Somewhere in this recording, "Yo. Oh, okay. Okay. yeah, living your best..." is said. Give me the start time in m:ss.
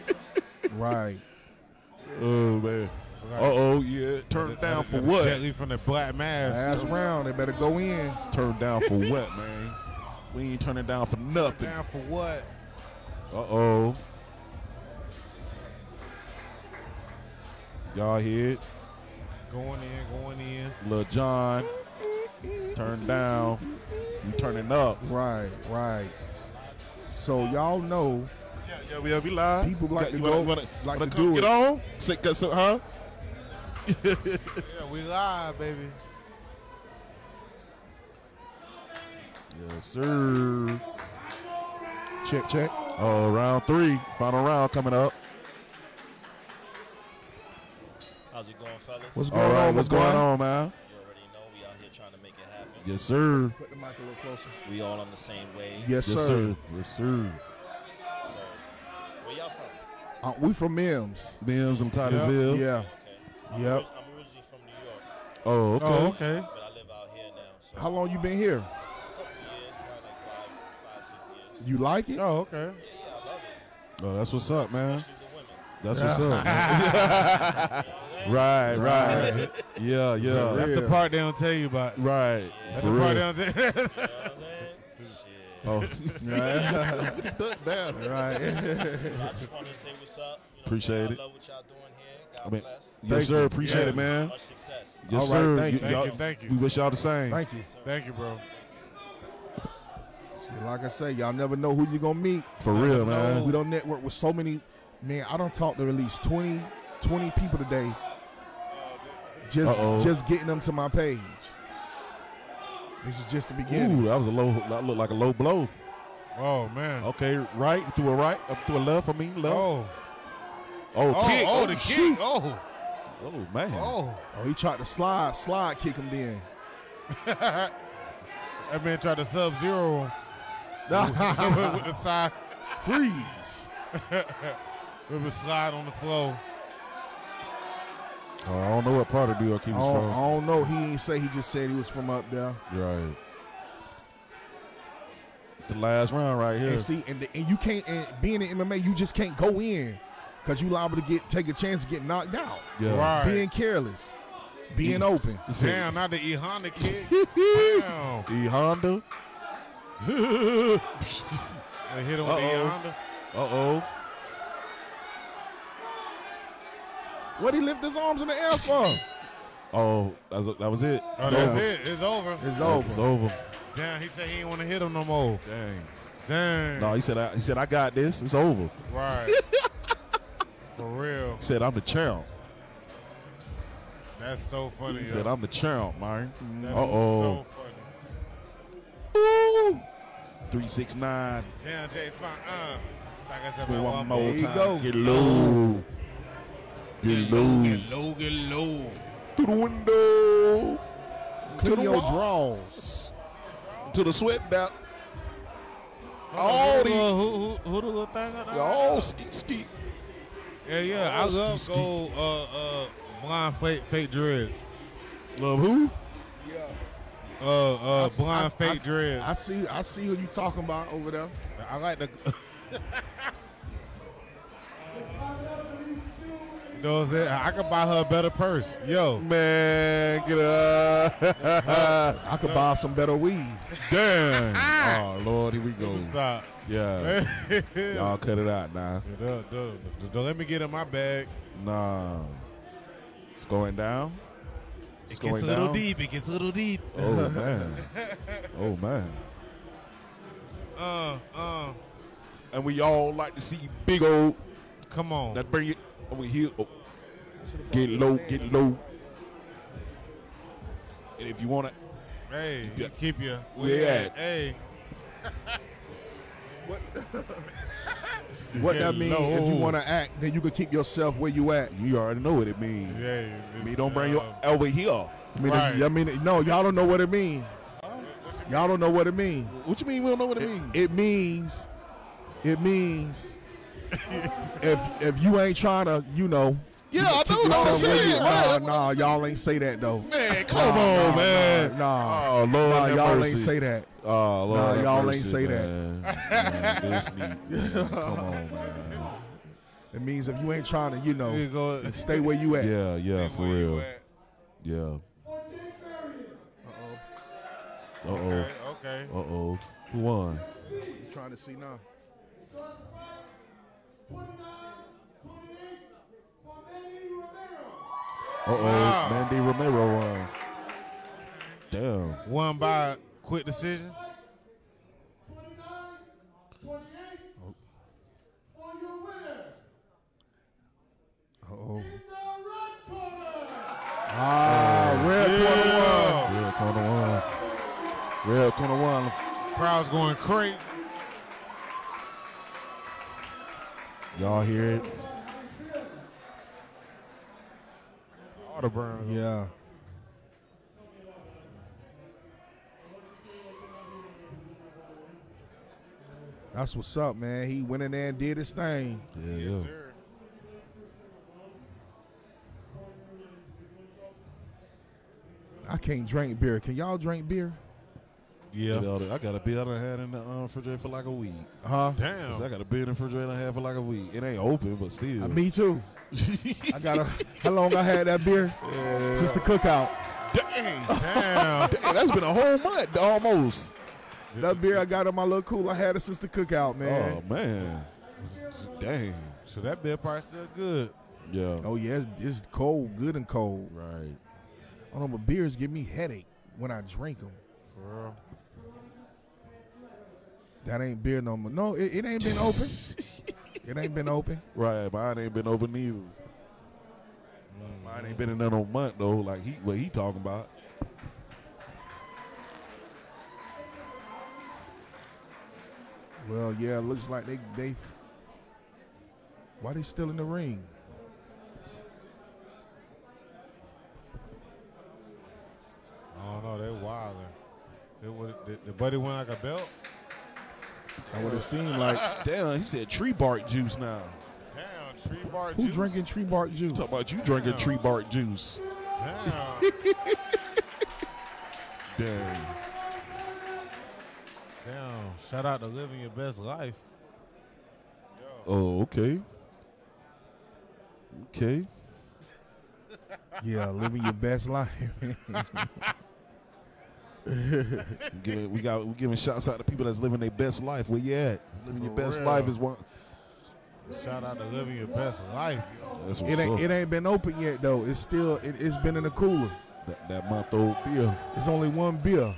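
7:28.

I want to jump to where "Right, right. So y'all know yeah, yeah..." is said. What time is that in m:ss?
0:25.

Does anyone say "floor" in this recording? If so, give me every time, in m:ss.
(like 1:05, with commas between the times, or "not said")
2:15.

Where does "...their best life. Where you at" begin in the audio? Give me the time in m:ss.
7:40.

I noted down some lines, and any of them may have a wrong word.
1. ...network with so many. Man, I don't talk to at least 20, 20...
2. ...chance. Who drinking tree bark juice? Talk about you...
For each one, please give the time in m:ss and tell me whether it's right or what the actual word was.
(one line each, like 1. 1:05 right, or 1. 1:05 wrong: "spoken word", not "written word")
1. 1:43 right
2. 7:15 wrong: "juice", not "chance".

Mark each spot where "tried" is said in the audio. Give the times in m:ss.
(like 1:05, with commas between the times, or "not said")
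2:04, 2:08.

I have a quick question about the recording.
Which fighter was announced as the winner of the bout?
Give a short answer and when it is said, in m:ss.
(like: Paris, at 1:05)
Manny Romero, at 5:19.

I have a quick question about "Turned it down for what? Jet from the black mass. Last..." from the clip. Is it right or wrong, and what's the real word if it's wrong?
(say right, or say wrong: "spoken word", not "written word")
right.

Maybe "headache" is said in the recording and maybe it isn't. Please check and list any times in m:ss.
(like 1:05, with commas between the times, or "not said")
6:35.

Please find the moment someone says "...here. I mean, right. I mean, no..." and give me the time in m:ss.
4:34.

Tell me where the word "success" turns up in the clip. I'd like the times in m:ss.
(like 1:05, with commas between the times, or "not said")
1:34.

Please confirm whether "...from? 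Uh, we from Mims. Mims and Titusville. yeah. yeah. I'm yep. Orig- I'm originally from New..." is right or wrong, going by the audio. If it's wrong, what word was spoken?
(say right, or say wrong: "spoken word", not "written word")
right.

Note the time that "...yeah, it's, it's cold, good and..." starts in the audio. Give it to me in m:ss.
6:31.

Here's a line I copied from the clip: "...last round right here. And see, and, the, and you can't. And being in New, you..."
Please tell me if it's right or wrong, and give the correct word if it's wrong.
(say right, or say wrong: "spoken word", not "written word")
wrong: "MMA", not "New".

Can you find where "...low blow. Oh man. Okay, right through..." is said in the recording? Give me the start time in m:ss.
1:55.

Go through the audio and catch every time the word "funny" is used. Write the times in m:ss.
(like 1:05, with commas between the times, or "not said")
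3:04.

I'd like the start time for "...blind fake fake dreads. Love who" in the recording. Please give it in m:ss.
3:33.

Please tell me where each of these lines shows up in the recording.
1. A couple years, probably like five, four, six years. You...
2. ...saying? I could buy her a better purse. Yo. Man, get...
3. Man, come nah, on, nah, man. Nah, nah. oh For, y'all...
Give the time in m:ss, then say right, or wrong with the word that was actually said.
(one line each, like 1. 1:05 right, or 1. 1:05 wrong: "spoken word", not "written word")
1. 1:08 wrong: "five", not "four"
2. 3:47 right
3. 4:50 wrong: "Lord", not "For".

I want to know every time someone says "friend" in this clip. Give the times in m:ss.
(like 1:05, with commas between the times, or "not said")
not said.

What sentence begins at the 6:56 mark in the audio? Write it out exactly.
Well, yeah, looks like they they.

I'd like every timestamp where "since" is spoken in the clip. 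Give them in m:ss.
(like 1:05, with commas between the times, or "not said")
6:19, 6:26.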